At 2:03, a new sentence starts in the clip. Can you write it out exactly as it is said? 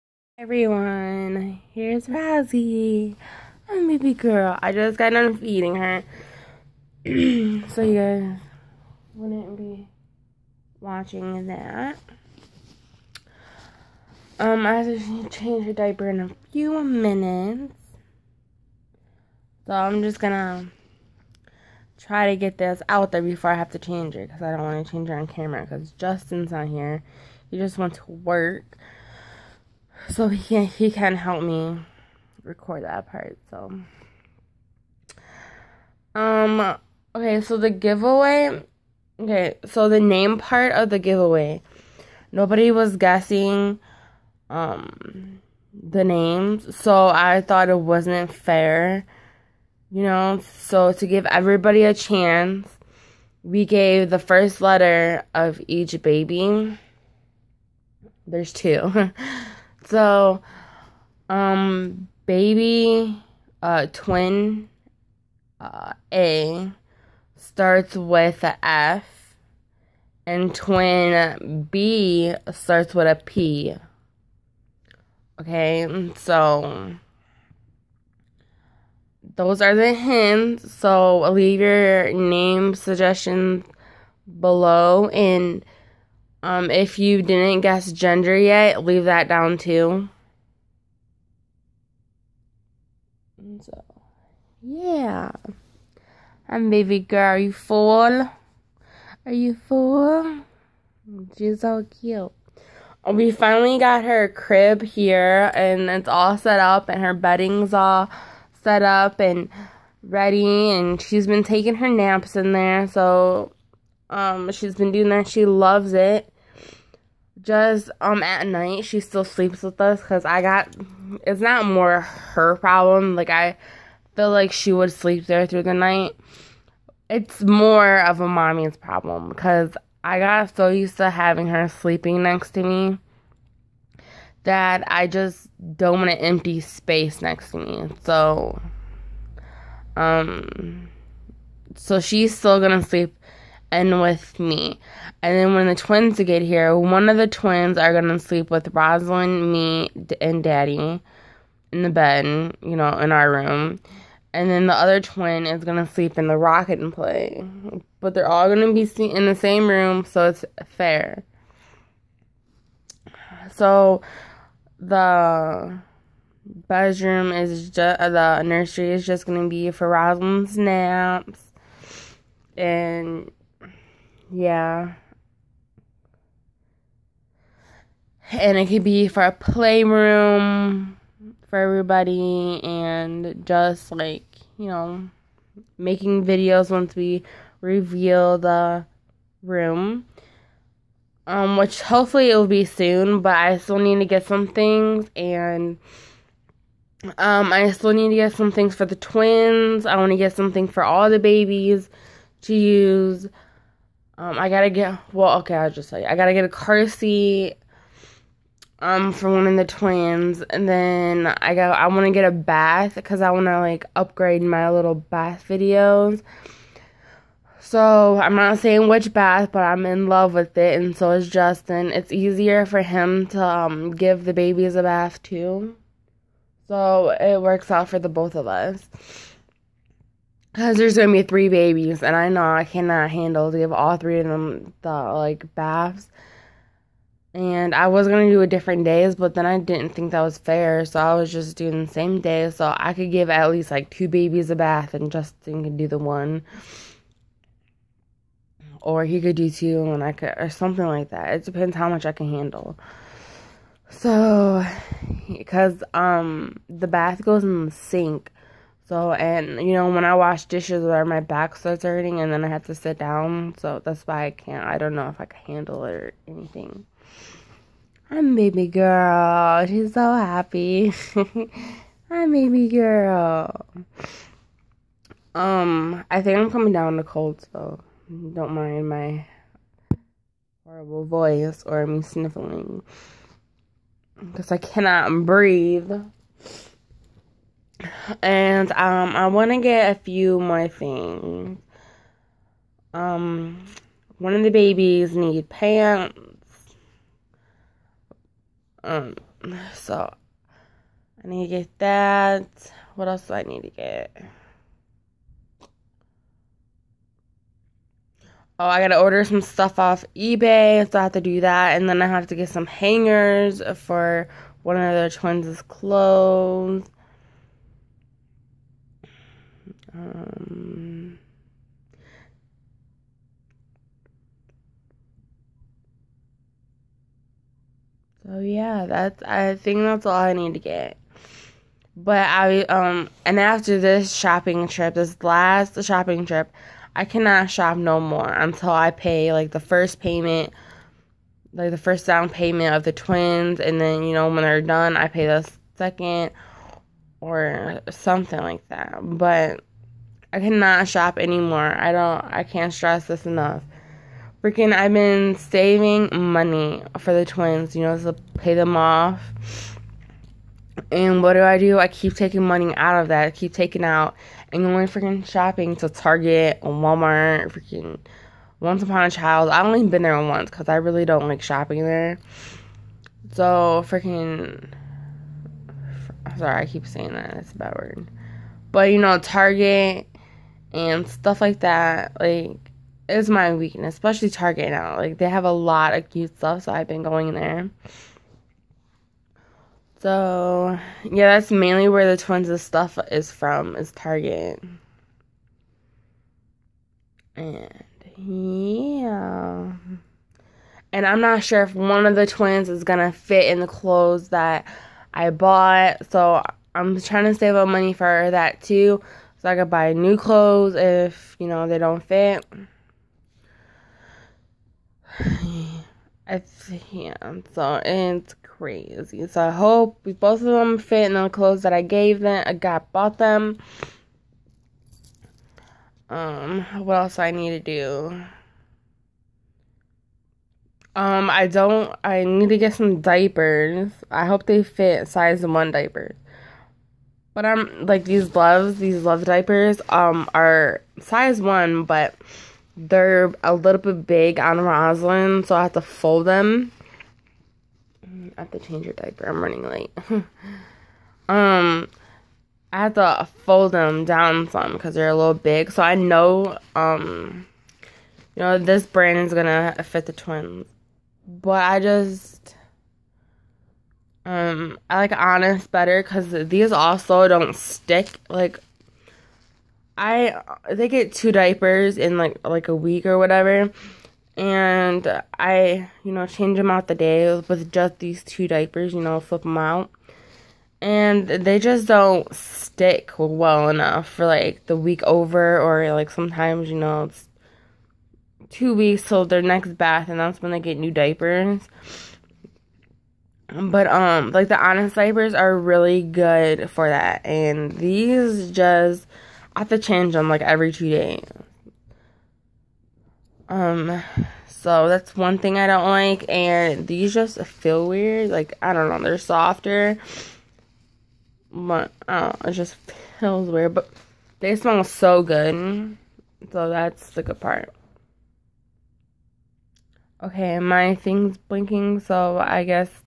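Like I feel like she would sleep there through the night.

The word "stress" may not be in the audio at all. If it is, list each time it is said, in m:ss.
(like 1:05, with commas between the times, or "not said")
5:52.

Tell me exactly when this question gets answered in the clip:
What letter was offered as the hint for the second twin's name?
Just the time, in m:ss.
1:13.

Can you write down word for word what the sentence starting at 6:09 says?
I've only been there once because I really don't like shopping there.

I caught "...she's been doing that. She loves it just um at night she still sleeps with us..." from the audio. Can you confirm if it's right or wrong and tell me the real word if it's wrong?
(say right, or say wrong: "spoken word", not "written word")
right.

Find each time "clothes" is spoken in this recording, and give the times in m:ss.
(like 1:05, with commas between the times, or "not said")
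5:15, 6:43, 6:50, 7:01.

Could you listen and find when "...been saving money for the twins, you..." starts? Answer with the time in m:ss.
5:54.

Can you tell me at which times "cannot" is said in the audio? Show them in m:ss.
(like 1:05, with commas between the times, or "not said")
3:52, 4:44, 5:37, 5:50.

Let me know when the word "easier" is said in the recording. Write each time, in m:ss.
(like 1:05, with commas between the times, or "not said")
3:42.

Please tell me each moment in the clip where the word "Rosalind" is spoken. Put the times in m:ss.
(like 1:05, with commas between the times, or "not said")
2:28, 2:49.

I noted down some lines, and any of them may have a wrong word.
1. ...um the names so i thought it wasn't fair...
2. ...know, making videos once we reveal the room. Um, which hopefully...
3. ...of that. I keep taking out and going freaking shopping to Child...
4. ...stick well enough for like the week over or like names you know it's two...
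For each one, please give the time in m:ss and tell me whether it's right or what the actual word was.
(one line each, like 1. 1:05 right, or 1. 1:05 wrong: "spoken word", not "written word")
1. 0:44 right
2. 3:04 right
3. 6:03 wrong: "Target", not "Child"
4. 8:02 wrong: "sometimes", not "names".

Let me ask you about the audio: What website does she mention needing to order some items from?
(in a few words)
eBay.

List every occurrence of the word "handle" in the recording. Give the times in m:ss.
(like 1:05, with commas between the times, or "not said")
3:53, 4:12, 4:25.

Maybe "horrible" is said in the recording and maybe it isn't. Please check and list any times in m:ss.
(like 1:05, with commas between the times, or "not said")
4:40.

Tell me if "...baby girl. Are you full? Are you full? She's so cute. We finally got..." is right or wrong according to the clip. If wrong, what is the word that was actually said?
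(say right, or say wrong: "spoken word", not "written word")
right.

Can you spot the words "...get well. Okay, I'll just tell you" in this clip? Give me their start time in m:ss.
3:24.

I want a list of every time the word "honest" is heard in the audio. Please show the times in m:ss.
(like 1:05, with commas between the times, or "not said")
7:45, 8:14.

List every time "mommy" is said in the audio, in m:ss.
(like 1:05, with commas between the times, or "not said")
2:08.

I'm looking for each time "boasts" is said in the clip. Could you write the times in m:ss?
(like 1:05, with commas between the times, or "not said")
not said.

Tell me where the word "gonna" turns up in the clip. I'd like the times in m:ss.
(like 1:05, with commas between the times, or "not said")
0:20, 2:22, 3:50, 3:58, 6:42, 7:39.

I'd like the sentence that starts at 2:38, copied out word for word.
But they're all going to be in the same room, so it's fair.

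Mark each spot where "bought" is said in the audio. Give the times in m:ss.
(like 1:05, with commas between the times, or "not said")
6:45, 7:02.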